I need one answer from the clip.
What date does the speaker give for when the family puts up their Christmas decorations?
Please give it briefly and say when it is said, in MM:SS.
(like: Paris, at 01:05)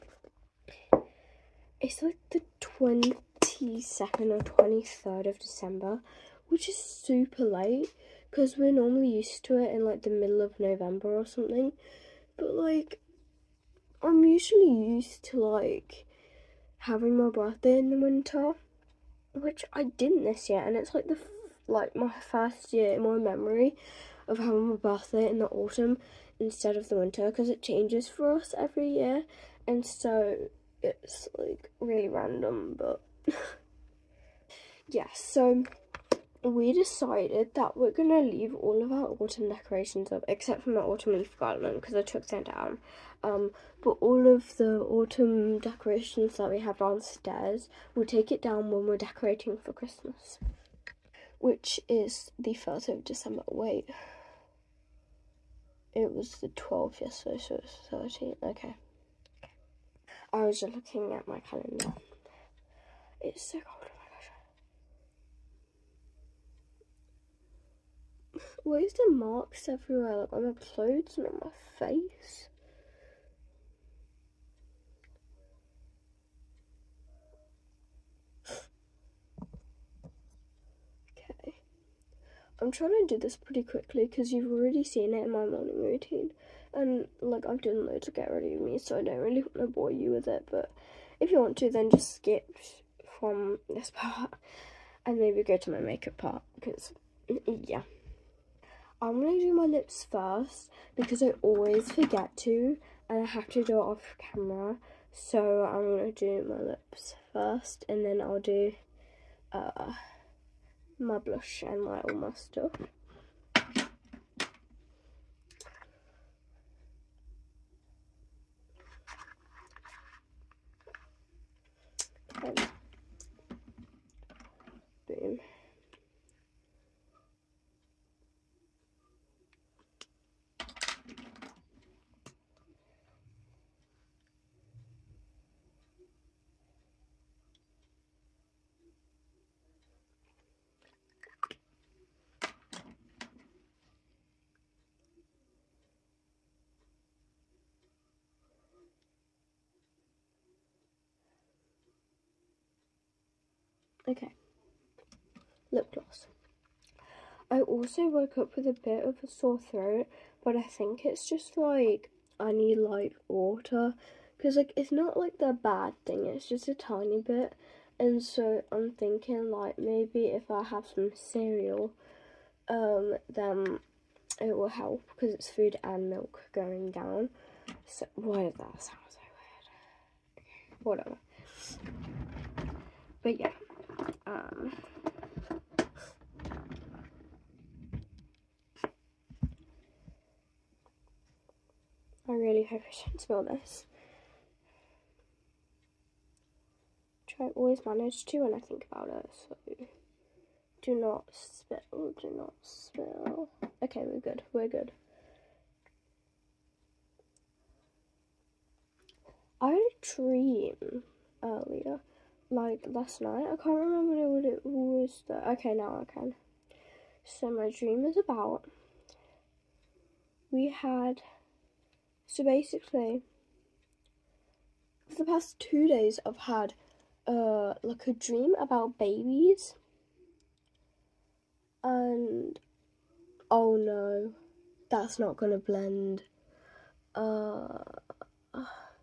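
1st of December, at 00:52.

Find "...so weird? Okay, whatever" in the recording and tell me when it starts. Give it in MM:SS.
02:59.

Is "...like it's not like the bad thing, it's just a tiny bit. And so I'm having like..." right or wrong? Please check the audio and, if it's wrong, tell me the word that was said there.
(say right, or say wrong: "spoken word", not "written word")
wrong: "thinking", not "having".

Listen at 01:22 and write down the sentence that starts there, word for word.
I'm trying to do this pretty quickly because you've already seen it in my morning routine.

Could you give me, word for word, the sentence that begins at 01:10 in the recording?
Like on my clothes and on my face?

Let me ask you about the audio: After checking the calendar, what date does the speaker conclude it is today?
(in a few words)
13.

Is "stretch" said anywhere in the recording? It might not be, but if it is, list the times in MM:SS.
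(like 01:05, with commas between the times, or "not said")
not said.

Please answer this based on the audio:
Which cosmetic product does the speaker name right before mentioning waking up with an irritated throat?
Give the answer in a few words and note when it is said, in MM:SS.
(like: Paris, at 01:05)
Lip gloss, at 02:35.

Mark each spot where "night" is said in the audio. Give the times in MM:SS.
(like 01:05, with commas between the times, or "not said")
03:33.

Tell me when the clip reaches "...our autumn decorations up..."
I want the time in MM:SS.
00:38.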